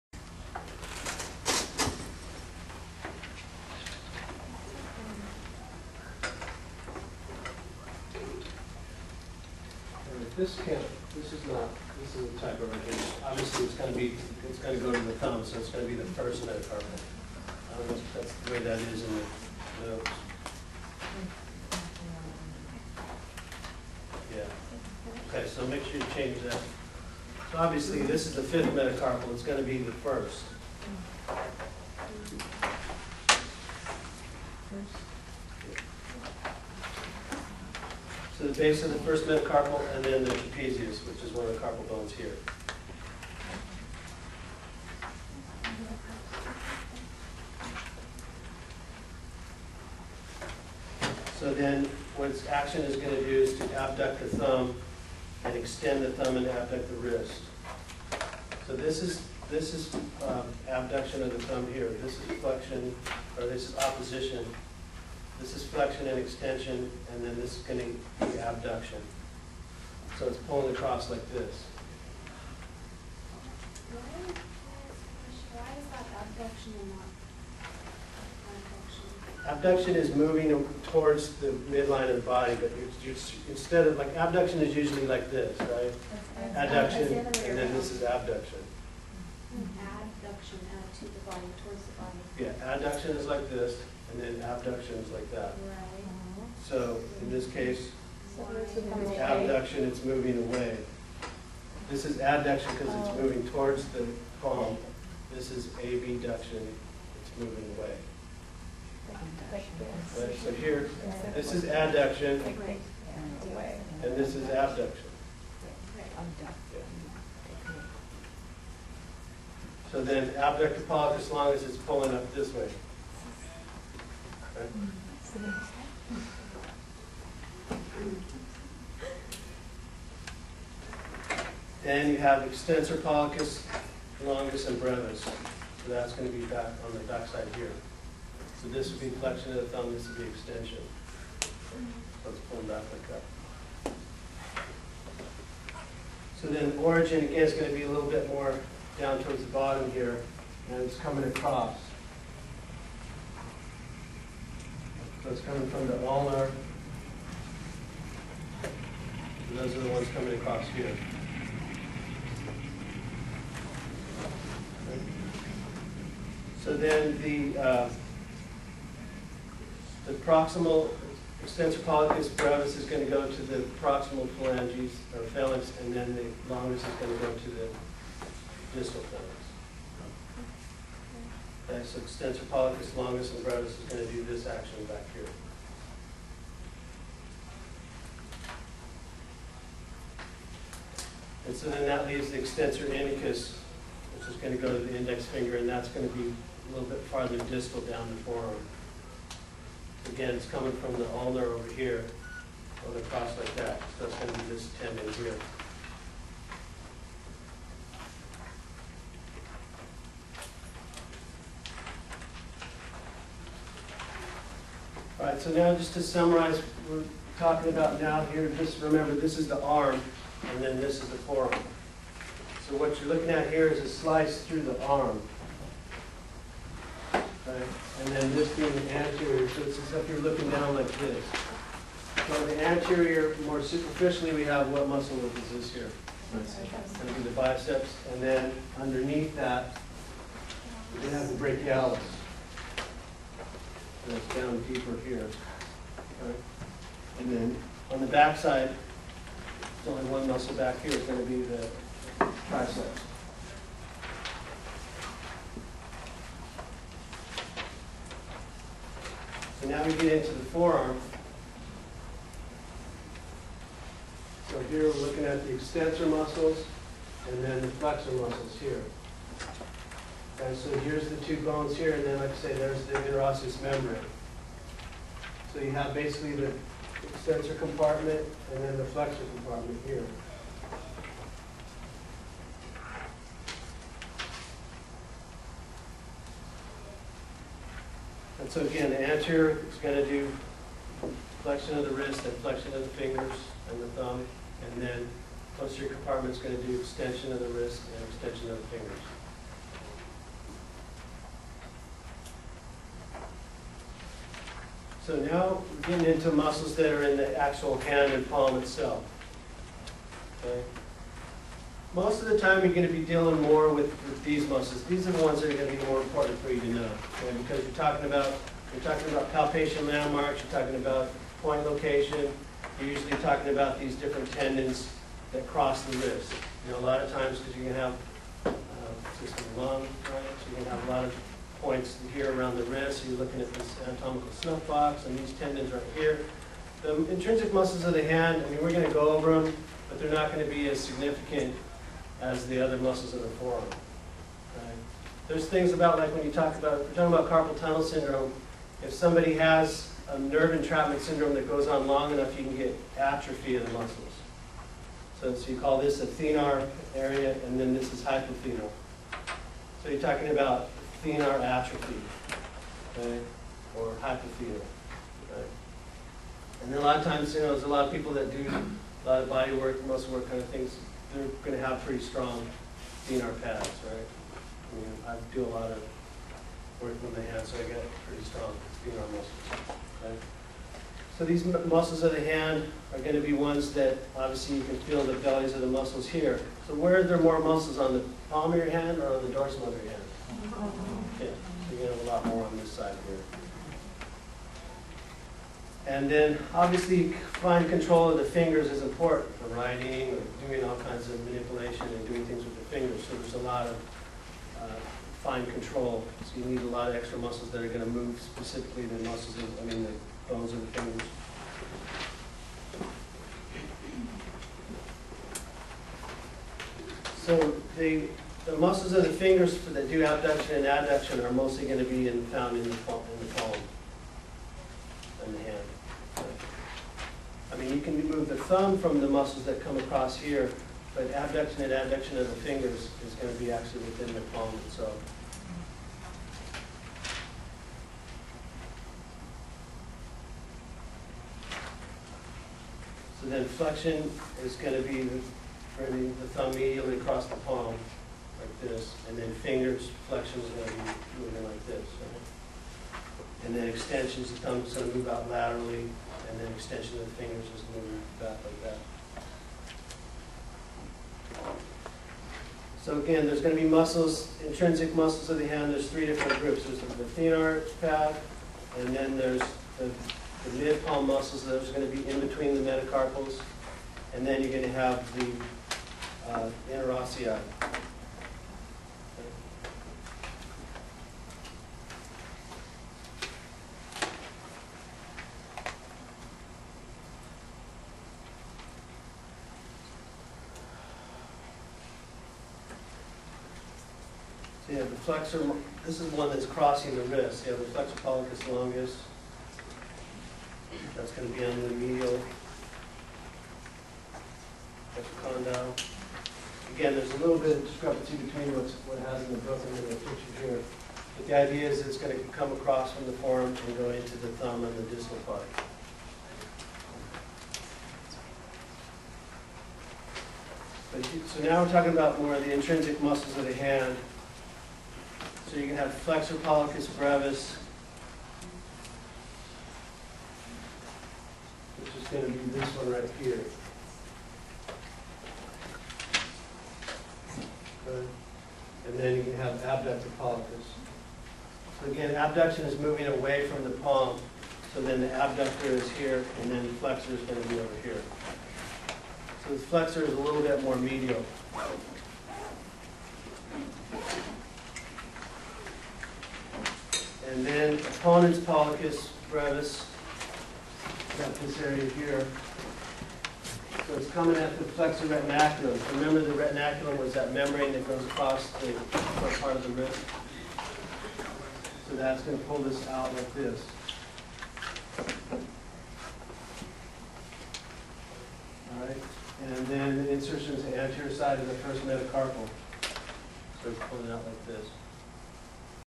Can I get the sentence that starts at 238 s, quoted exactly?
And then underneath that, we have the brachialis that's down deeper here.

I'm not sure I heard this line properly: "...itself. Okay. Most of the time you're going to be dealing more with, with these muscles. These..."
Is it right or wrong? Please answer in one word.
right.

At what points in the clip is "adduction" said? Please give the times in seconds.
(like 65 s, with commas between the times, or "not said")
92 s, 102 s, 111 s, 420 s, 431 s.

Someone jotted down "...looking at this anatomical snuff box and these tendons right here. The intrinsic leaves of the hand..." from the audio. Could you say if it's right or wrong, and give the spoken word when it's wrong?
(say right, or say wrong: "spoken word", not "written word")
wrong: "muscles", not "leaves".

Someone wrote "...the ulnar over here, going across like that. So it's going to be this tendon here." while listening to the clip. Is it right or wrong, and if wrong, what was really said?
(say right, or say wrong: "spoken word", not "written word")
right.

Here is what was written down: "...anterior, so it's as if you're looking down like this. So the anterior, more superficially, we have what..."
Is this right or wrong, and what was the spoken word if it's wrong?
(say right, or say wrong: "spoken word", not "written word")
right.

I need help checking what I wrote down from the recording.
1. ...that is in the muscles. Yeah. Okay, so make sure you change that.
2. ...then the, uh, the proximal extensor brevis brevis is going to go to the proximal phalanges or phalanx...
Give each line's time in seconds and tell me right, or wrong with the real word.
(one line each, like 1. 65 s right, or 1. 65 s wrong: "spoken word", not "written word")
1. 18 s wrong: "notes", not "muscles"
2. 166 s wrong: "pollicis", not "brevis".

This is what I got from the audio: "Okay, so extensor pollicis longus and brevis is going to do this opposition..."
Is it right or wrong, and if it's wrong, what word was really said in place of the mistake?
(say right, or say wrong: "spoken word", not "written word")
wrong: "action", not "opposition".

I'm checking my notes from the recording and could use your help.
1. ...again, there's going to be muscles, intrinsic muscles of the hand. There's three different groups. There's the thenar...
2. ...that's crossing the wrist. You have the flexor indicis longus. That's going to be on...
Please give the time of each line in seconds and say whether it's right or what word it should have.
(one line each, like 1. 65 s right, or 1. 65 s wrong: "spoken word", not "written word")
1. 462 s right
2. 496 s wrong: "pollicis", not "indicis".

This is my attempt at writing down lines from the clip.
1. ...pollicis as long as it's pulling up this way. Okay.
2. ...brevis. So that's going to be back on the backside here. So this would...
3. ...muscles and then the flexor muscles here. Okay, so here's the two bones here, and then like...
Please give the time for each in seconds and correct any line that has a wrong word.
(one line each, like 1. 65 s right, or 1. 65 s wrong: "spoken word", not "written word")
1. 120 s right
2. 134 s right
3. 266 s right.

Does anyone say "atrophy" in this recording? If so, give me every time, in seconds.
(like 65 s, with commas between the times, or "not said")
352 s, 361 s.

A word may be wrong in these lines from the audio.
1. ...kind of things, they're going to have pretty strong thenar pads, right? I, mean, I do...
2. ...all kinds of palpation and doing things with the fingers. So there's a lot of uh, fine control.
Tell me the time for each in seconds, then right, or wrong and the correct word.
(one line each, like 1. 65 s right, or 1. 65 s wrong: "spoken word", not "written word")
1. 370 s right
2. 400 s wrong: "manipulation", not "palpation".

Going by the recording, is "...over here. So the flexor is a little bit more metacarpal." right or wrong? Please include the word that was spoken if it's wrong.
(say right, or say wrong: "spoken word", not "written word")
wrong: "medial", not "metacarpal".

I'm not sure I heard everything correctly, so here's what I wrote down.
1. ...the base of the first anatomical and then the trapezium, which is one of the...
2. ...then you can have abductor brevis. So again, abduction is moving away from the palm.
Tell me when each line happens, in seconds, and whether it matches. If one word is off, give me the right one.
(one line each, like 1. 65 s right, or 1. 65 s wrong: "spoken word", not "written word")
1. 38 s wrong: "metacarpal", not "anatomical"
2. 538 s wrong: "pollicis", not "brevis".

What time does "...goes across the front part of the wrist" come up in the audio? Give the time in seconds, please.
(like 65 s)
567 s.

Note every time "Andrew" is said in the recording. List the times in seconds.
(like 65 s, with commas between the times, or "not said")
not said.